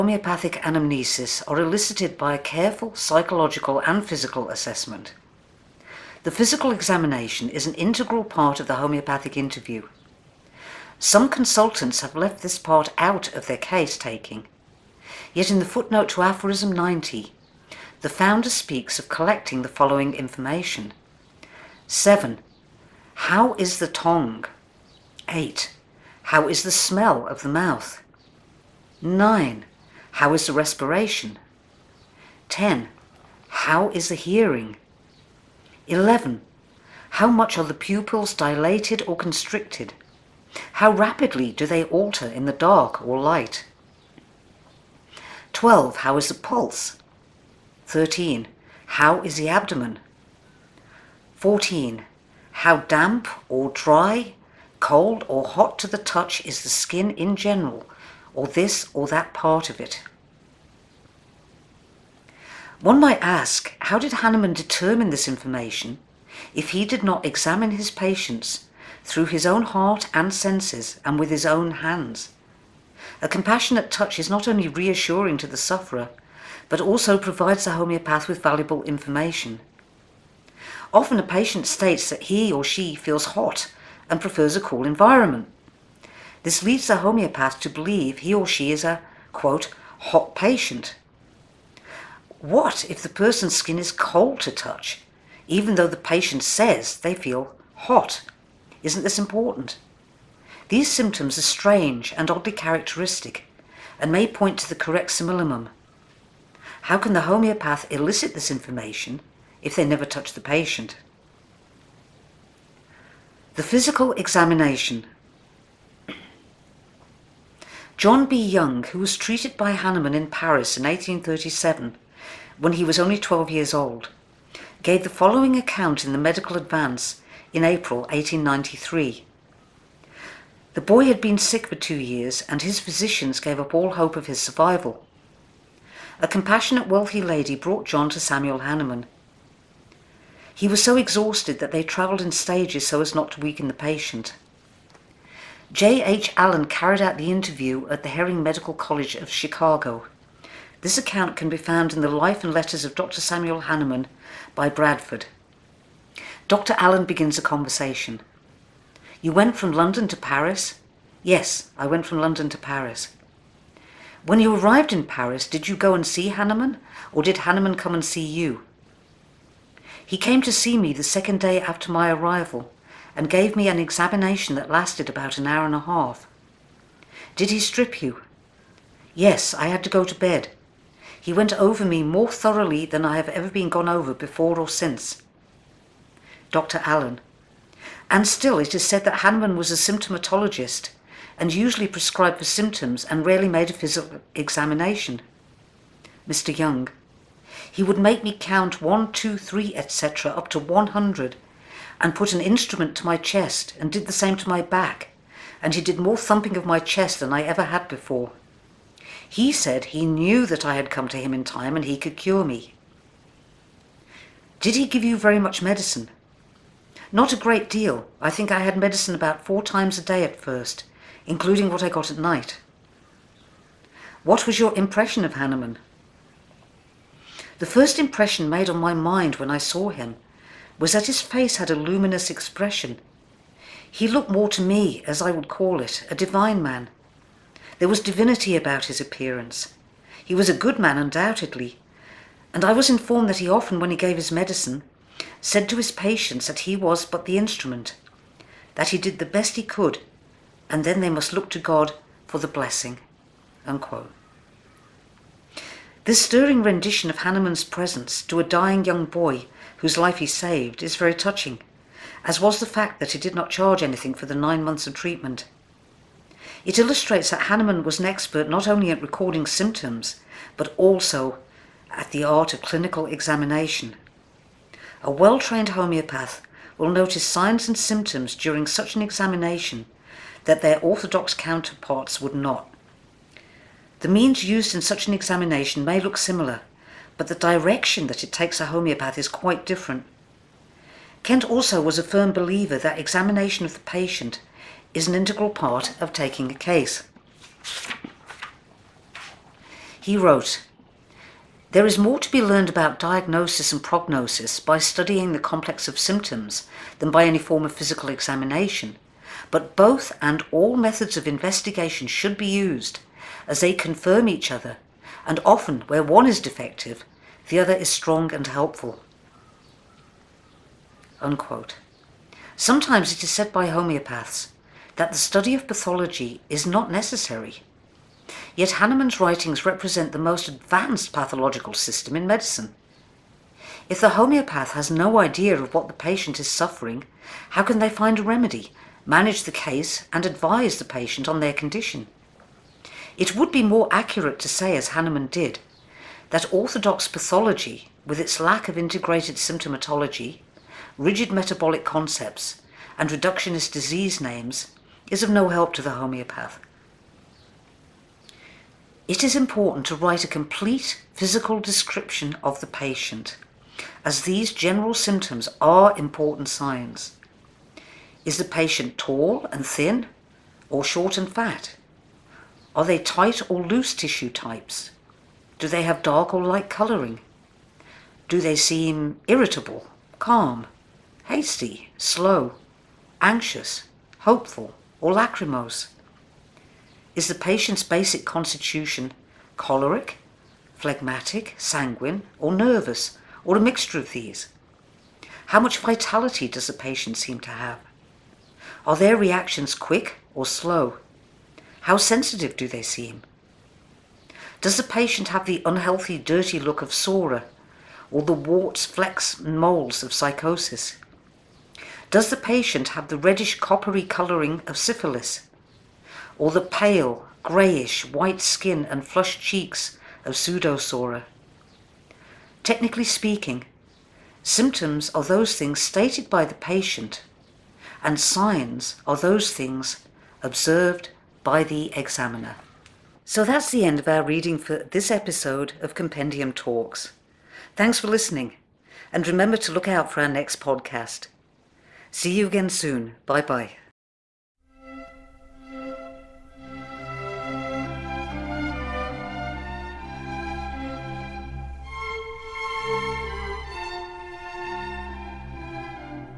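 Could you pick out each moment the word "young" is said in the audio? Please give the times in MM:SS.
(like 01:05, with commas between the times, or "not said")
01:58, 03:16, 04:18.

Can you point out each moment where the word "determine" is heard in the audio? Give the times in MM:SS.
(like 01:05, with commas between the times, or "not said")
01:04.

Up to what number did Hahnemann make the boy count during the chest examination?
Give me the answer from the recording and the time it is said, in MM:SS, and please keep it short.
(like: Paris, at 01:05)
100, at 03:20.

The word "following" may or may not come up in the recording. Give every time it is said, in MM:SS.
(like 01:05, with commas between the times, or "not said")
00:19, 02:05.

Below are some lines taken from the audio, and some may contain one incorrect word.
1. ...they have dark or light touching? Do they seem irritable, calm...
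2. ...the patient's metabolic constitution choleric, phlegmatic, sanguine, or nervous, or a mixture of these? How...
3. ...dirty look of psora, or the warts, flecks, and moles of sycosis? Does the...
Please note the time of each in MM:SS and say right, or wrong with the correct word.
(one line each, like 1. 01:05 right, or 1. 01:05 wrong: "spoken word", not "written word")
1. 06:15 wrong: "colouring", not "touching"
2. 06:27 wrong: "basic", not "metabolic"
3. 06:46 right.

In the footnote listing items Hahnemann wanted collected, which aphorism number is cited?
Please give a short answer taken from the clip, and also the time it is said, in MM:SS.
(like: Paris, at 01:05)
90, at 00:16.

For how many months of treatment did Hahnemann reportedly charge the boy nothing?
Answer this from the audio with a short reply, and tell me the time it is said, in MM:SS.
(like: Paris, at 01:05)
9, at 04:24.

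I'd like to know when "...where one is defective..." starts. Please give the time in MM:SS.
05:15.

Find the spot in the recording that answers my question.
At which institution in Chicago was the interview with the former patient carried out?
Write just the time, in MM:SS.
02:28.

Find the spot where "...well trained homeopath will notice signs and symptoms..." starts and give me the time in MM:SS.
04:35.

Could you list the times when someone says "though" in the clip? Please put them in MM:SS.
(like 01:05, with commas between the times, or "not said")
01:35.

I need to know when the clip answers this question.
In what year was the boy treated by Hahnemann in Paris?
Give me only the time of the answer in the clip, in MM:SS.
02:00.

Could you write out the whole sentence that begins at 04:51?
Kent also was a firm believer that examination of the patient is an integral part of taking a case.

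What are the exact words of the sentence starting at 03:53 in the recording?
He looked more to me, as I would call it, a divine man.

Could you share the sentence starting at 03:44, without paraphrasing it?
What was your impression of Hahnemann?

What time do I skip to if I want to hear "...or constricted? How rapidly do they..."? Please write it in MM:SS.
00:39.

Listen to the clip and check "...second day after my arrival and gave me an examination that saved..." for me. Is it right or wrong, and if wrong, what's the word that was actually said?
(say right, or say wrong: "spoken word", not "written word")
wrong: "lasted", not "saved".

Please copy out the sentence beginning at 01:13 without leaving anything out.
A compassionate touch is not only reassuring to the sufferer, but also provides the homeopath with valuable information.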